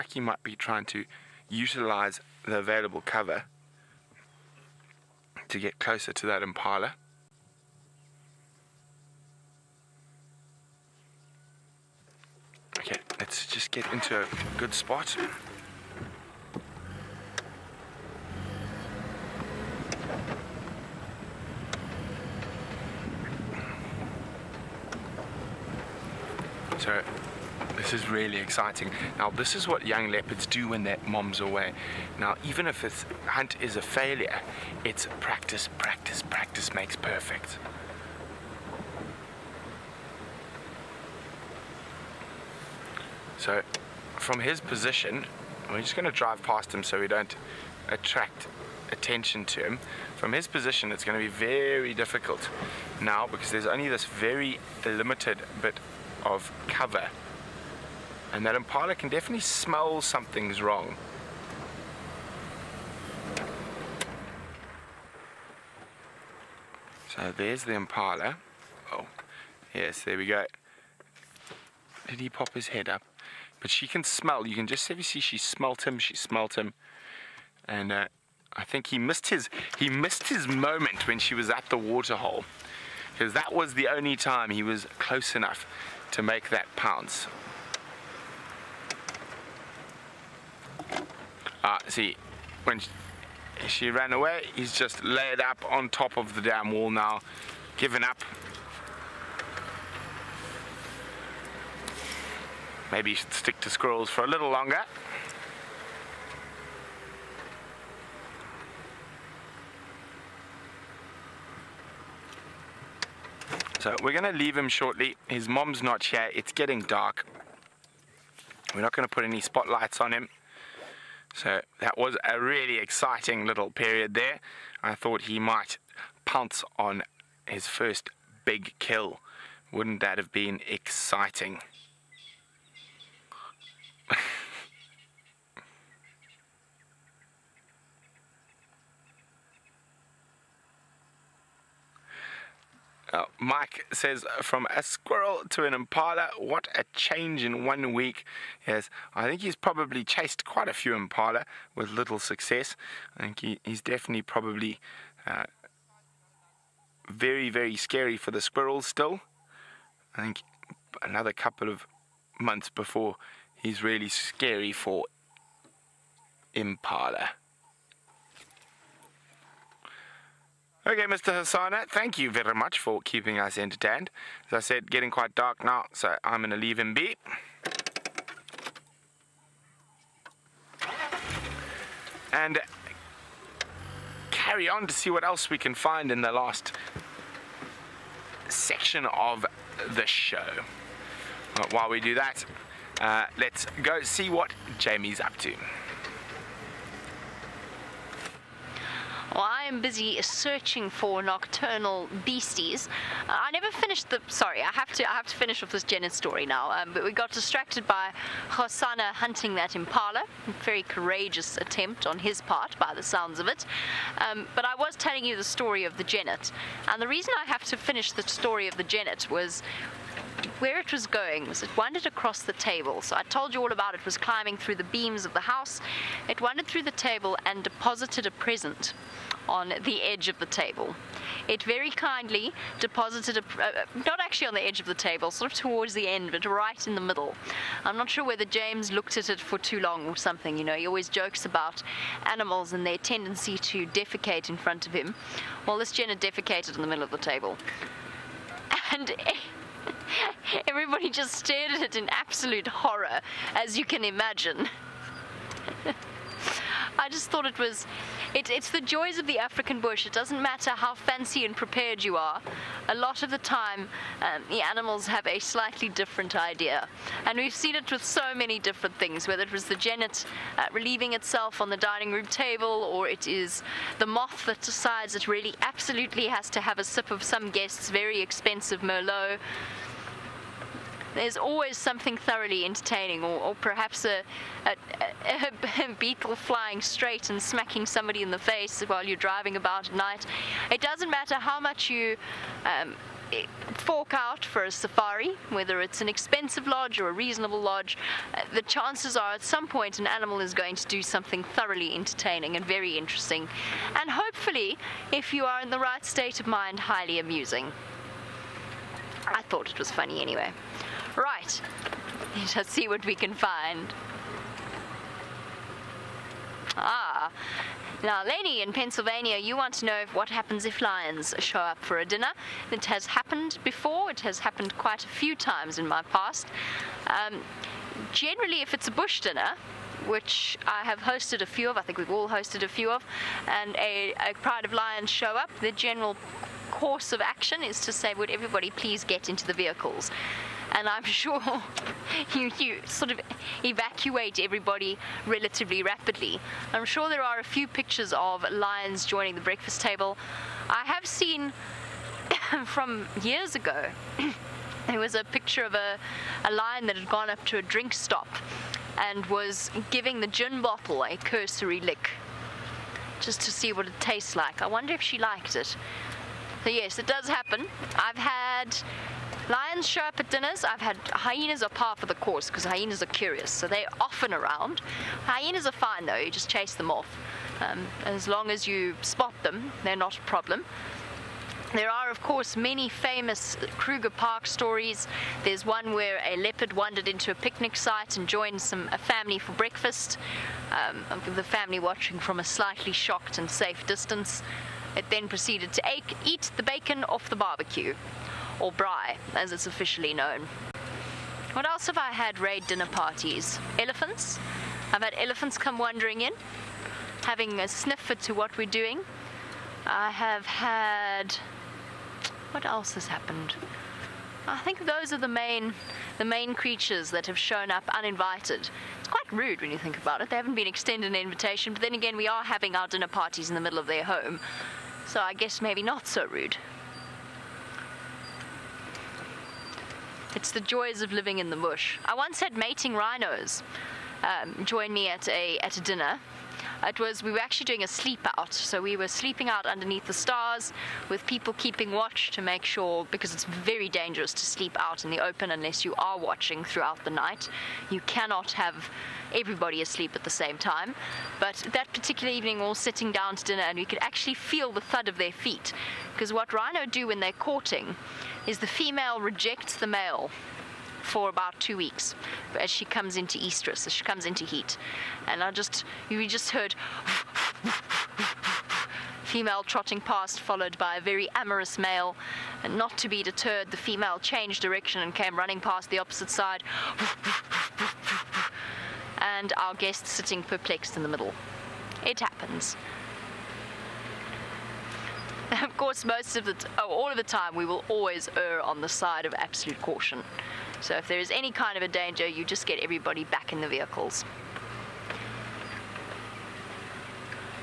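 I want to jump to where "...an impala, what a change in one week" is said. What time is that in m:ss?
2:25.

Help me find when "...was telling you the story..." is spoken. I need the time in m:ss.
3:34.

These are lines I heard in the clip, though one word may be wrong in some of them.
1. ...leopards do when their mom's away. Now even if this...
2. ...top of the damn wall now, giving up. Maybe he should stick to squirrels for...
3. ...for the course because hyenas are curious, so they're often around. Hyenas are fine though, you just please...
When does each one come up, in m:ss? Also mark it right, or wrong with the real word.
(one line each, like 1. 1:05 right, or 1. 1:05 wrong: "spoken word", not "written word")
1. 0:30 right
2. 1:35 right
3. 6:11 wrong: "chase", not "please".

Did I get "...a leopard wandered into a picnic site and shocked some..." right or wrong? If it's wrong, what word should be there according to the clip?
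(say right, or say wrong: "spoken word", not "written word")
wrong: "joined", not "shocked".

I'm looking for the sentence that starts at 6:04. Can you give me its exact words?
I wonder if she liked it.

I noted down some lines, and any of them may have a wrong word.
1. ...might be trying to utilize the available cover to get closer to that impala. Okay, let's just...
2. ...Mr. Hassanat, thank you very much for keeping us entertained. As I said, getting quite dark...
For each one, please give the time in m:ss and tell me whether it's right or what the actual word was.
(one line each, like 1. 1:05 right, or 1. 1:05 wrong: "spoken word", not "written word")
1. 0:00 right
2. 2:51 right.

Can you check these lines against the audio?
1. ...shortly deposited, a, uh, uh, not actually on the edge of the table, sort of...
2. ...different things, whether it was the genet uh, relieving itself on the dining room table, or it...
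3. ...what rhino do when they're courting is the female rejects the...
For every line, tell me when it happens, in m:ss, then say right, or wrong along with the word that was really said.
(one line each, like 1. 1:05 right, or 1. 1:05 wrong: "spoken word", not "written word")
1. 3:51 wrong: "kindly", not "shortly"
2. 4:28 right
3. 7:36 right.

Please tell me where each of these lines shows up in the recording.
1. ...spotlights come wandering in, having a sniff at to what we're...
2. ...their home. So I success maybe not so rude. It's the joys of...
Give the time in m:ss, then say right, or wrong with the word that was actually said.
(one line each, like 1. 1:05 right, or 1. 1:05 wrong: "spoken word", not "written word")
1. 6:45 wrong: "elephants", not "spotlights"
2. 7:03 wrong: "guess", not "success".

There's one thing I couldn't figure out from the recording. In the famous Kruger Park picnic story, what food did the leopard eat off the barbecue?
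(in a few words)
bacon.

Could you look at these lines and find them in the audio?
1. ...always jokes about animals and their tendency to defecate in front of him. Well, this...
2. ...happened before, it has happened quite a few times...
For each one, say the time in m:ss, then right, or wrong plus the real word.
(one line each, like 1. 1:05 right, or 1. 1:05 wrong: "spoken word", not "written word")
1. 4:00 right
2. 5:23 right.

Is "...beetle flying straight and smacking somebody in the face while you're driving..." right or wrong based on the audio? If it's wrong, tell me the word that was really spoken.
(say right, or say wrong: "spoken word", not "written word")
right.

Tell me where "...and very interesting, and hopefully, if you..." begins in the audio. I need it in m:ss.
5:02.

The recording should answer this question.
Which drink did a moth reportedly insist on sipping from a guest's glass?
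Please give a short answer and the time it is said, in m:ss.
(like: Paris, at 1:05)
Merlot, at 4:38.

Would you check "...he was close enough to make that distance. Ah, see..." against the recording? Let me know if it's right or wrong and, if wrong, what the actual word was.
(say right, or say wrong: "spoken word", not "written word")
wrong: "pounce", not "distance".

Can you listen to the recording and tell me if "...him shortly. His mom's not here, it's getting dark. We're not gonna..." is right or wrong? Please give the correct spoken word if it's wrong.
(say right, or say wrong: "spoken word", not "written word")
right.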